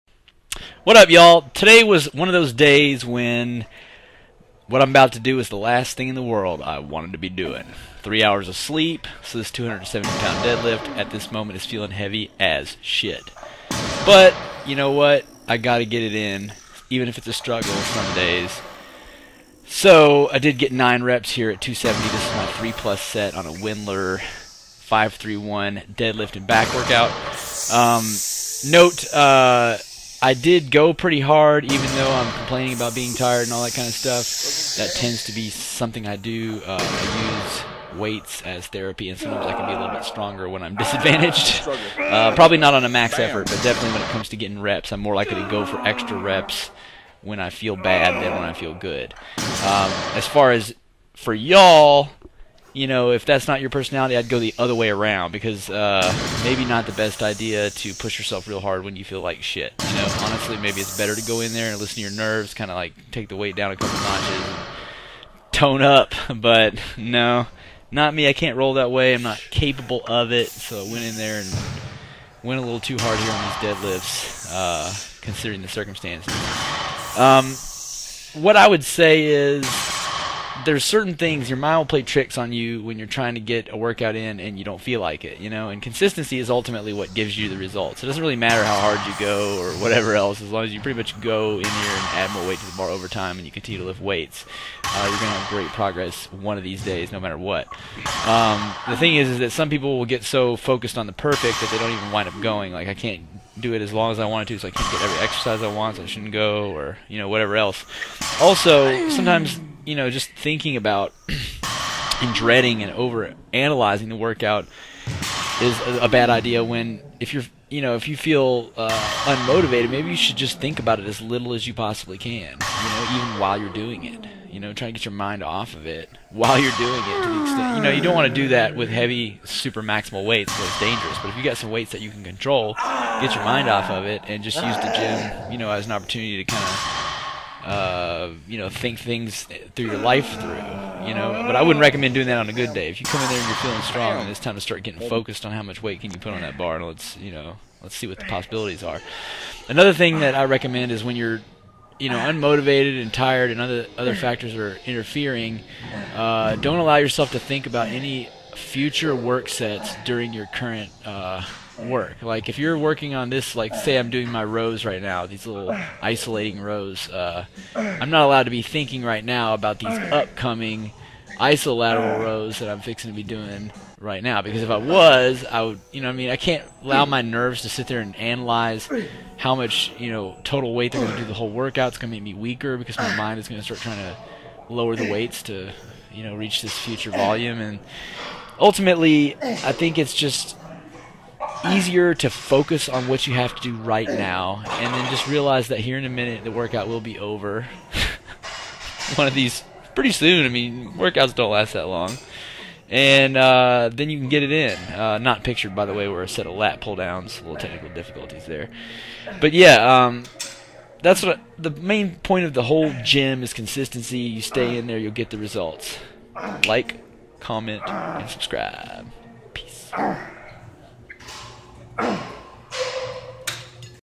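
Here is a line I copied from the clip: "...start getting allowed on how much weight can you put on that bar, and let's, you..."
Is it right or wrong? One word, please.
wrong.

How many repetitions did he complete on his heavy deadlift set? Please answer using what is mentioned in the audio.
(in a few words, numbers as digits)
9.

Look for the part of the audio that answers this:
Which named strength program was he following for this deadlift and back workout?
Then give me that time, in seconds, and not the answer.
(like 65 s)
23 s.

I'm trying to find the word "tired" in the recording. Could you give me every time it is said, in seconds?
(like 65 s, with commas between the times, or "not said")
33 s, 153 s.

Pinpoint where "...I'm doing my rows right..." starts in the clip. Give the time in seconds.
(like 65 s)
163 s.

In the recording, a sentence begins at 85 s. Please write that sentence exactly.
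And consistency is ultimately what gives you the results.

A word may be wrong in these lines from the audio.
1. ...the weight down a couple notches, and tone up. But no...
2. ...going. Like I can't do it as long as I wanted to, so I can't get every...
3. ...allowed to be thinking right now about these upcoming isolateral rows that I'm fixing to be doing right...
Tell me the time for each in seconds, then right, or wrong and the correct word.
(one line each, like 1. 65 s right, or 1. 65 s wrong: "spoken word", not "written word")
1. 63 s right
2. 102 s right
3. 168 s right.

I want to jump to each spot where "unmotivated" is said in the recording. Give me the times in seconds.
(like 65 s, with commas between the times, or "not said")
119 s, 152 s.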